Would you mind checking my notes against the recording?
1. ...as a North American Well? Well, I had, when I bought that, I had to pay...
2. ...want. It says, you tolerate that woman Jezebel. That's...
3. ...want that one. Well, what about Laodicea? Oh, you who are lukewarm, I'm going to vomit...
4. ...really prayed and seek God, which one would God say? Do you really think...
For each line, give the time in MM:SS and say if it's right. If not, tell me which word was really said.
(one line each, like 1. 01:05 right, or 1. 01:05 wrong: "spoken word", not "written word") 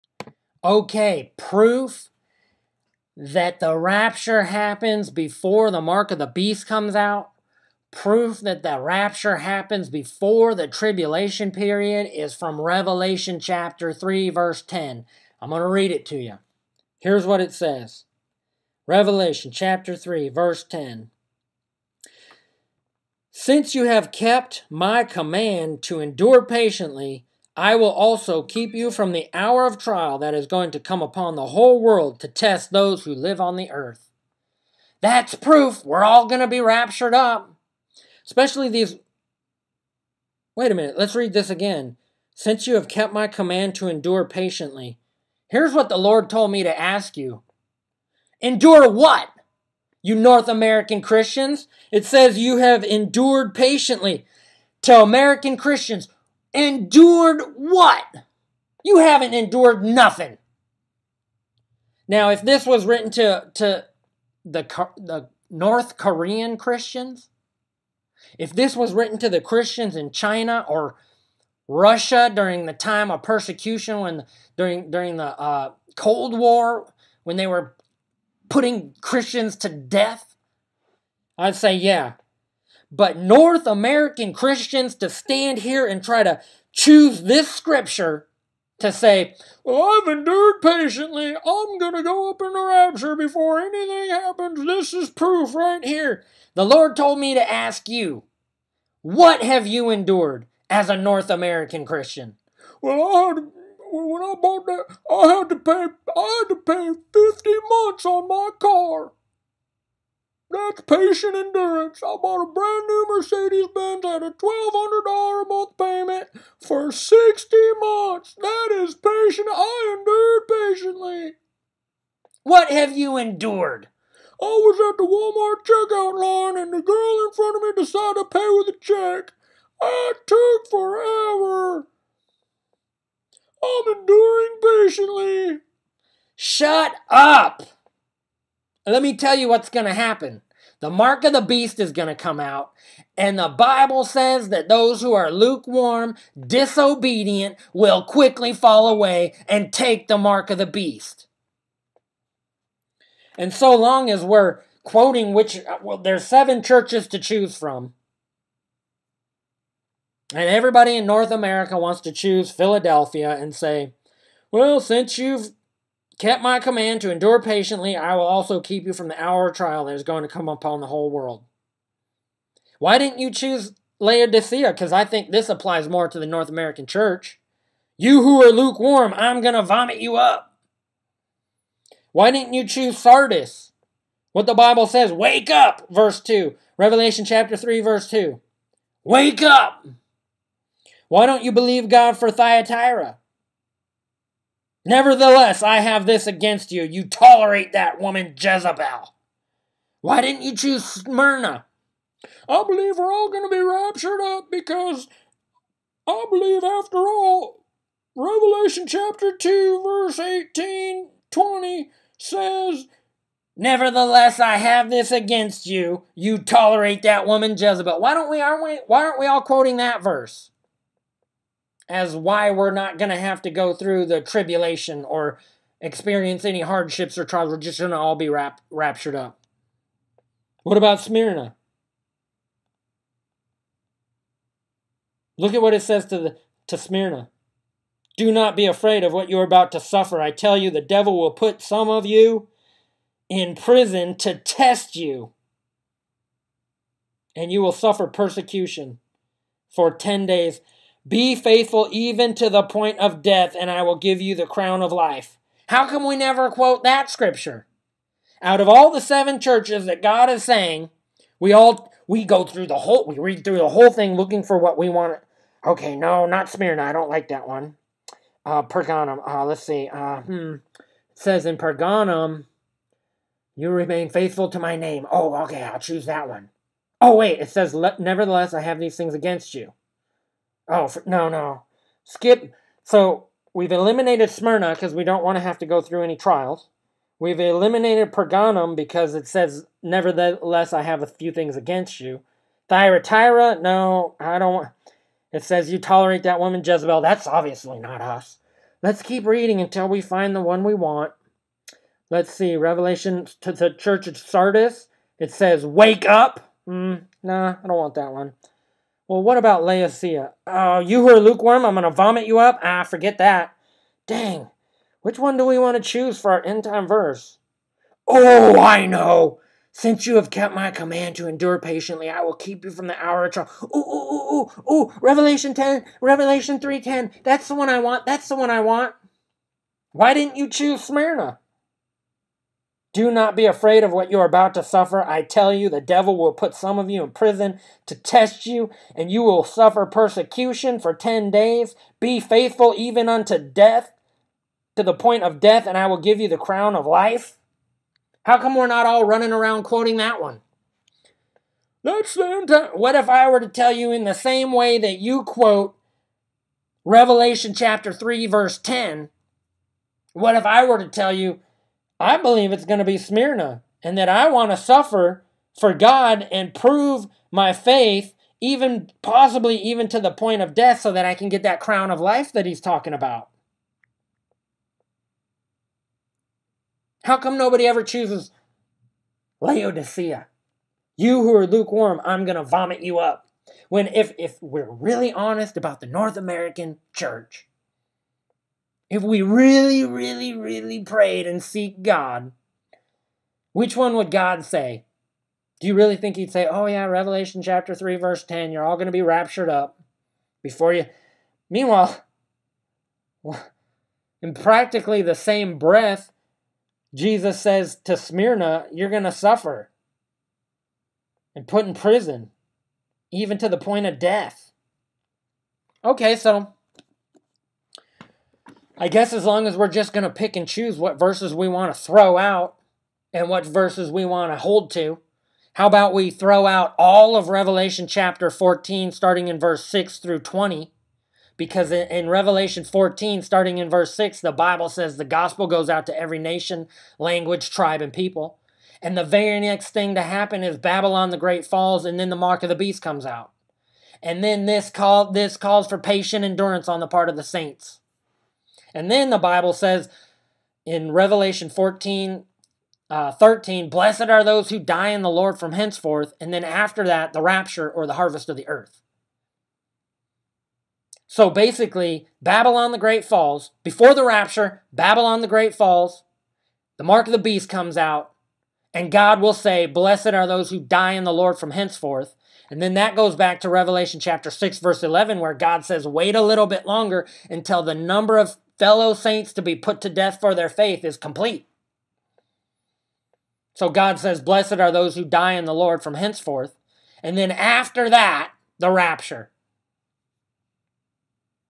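1. 01:40 wrong: "Christian", not "Well"
2. 04:54 right
3. 05:07 right
4. 06:30 right.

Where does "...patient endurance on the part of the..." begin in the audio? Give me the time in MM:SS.
07:25.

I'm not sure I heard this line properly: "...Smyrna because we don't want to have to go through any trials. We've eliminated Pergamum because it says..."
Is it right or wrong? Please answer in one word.
right.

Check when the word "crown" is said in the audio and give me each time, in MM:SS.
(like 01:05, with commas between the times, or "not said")
04:14, 05:46, 06:11.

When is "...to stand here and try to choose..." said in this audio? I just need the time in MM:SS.
01:24.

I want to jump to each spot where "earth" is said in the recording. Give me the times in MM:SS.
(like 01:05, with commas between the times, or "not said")
00:33, 07:38.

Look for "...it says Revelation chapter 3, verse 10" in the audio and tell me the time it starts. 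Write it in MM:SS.
00:17.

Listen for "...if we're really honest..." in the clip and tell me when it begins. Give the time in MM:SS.
06:24.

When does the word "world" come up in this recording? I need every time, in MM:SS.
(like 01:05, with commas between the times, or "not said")
00:31, 02:51.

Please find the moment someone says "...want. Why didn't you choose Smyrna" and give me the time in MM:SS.
05:28.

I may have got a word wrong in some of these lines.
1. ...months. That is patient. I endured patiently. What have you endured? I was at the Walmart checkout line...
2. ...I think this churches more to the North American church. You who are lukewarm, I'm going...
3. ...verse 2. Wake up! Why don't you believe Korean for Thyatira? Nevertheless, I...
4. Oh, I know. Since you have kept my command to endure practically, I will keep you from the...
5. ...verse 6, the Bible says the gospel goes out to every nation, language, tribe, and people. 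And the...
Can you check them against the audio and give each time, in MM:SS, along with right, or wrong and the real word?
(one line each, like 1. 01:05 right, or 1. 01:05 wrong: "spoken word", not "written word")
1. 01:57 right
2. 02:54 wrong: "applies", not "churches"
3. 03:07 wrong: "God", not "Korean"
4. 05:18 wrong: "patiently", not "practically"
5. 07:13 right.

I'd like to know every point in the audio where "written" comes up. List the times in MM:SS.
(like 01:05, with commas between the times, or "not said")
01:02, 01:08.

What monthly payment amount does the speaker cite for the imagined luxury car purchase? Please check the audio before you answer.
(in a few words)
$1,200.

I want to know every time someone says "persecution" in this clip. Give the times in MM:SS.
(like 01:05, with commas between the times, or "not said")
01:13, 04:08, 05:39.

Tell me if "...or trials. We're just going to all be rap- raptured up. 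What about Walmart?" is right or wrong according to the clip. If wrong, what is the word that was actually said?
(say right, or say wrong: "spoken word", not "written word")
wrong: "Smyrna", not "Walmart".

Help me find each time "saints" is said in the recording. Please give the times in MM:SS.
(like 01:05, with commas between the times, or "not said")
07:27, 07:58.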